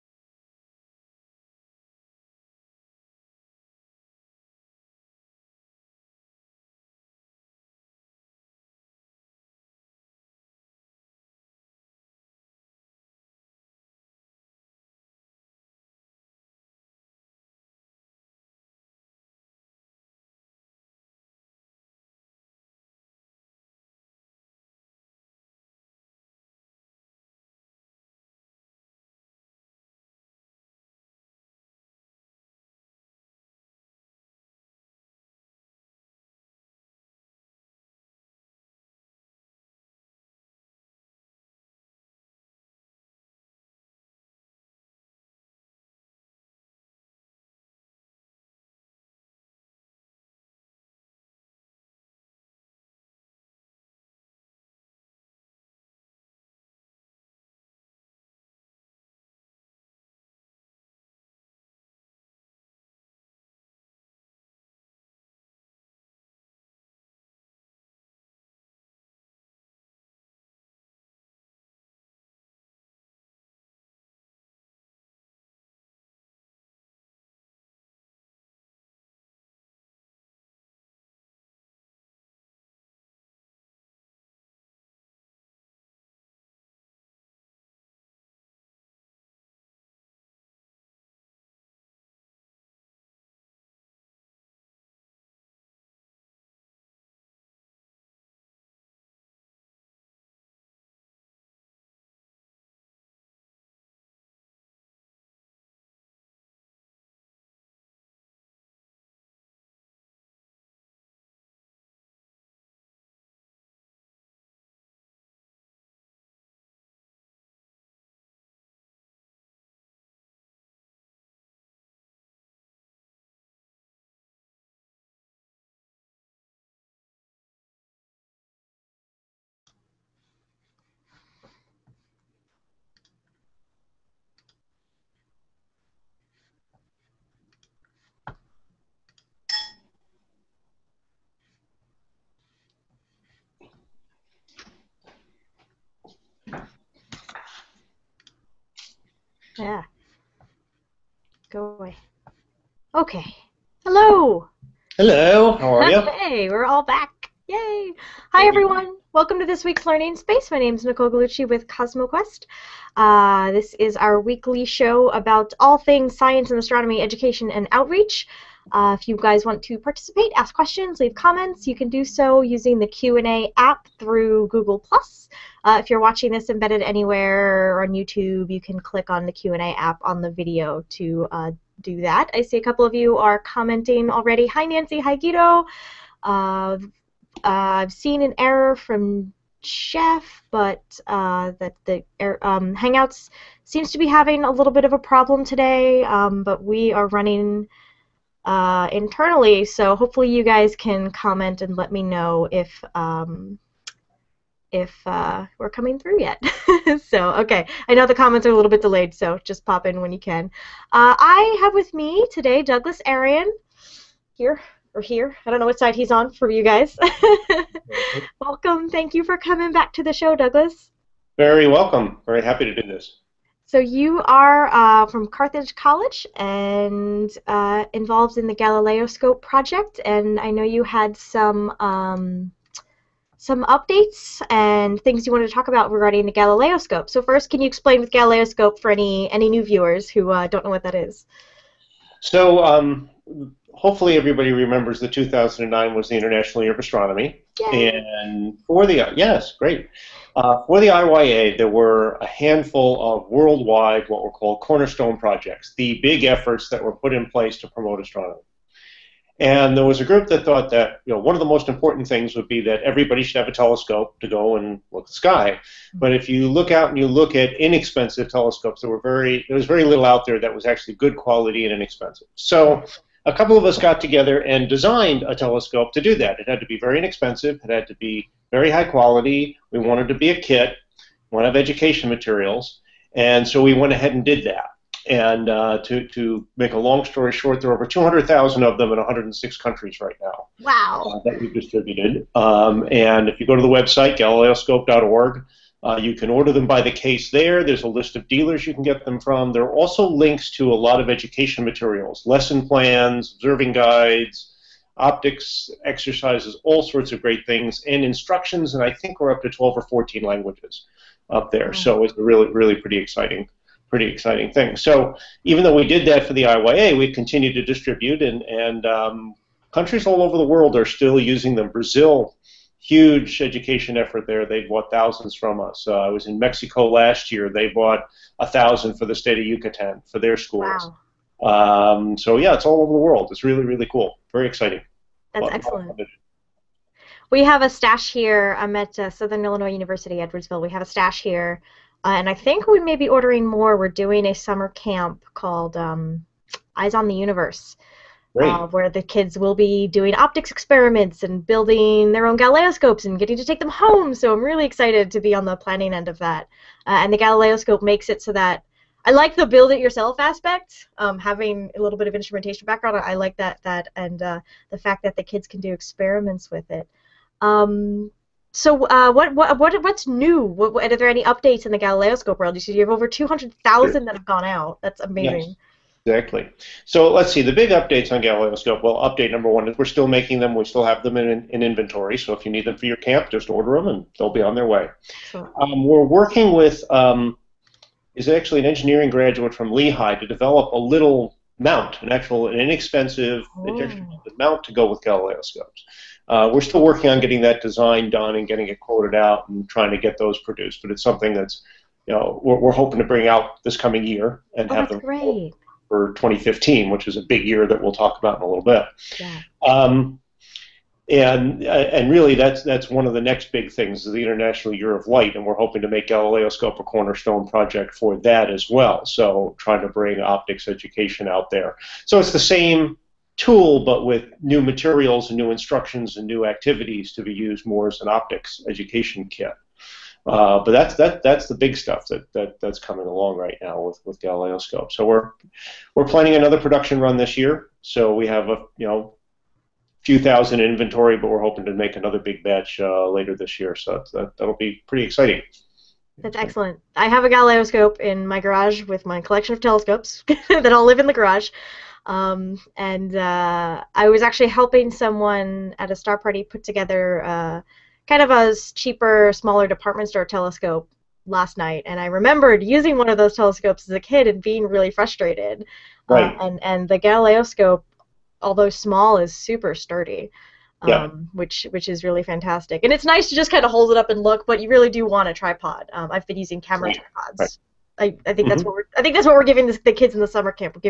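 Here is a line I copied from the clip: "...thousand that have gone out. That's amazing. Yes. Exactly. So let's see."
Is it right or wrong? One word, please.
right.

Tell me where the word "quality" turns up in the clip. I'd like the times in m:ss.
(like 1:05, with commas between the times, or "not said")
4:31, 4:38.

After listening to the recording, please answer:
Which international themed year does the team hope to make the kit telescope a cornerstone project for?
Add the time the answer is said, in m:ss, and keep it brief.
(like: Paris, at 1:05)
International Year of Light, at 6:54.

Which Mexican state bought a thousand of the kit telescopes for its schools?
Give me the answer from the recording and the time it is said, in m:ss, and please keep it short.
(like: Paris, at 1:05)
Yucatan, at 5:29.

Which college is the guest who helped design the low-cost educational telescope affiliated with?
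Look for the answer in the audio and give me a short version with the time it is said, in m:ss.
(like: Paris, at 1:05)
Carthage College, at 3:45.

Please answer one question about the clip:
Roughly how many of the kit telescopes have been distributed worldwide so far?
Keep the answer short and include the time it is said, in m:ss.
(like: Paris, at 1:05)
200,000, at 4:47.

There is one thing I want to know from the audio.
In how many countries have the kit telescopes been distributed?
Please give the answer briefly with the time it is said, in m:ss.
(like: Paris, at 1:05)
106, at 4:48.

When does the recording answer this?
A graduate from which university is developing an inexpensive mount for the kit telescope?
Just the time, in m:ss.
6:29.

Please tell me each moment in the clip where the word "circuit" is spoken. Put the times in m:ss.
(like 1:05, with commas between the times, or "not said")
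not said.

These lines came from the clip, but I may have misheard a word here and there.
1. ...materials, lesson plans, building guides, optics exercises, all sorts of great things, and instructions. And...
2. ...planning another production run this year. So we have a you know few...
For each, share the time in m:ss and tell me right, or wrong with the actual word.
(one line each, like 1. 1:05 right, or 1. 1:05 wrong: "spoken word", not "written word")
1. 5:01 wrong: "observing", not "building"
2. 7:16 right.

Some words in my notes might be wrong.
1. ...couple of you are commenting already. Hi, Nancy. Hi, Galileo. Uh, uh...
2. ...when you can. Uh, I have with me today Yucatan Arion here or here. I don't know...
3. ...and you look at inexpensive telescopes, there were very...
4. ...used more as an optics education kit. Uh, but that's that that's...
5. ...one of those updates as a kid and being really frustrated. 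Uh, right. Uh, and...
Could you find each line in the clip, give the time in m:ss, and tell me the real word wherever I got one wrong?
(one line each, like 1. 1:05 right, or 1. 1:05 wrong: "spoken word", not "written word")
1. 3:02 wrong: "Guido", not "Galileo"
2. 3:30 wrong: "Douglas", not "Yucatan"
3. 4:26 right
4. 7:07 right
5. 7:42 wrong: "telescopes", not "updates".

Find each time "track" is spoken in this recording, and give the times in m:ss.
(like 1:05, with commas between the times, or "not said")
not said.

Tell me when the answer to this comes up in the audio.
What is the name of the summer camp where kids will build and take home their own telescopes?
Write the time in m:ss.
5:46.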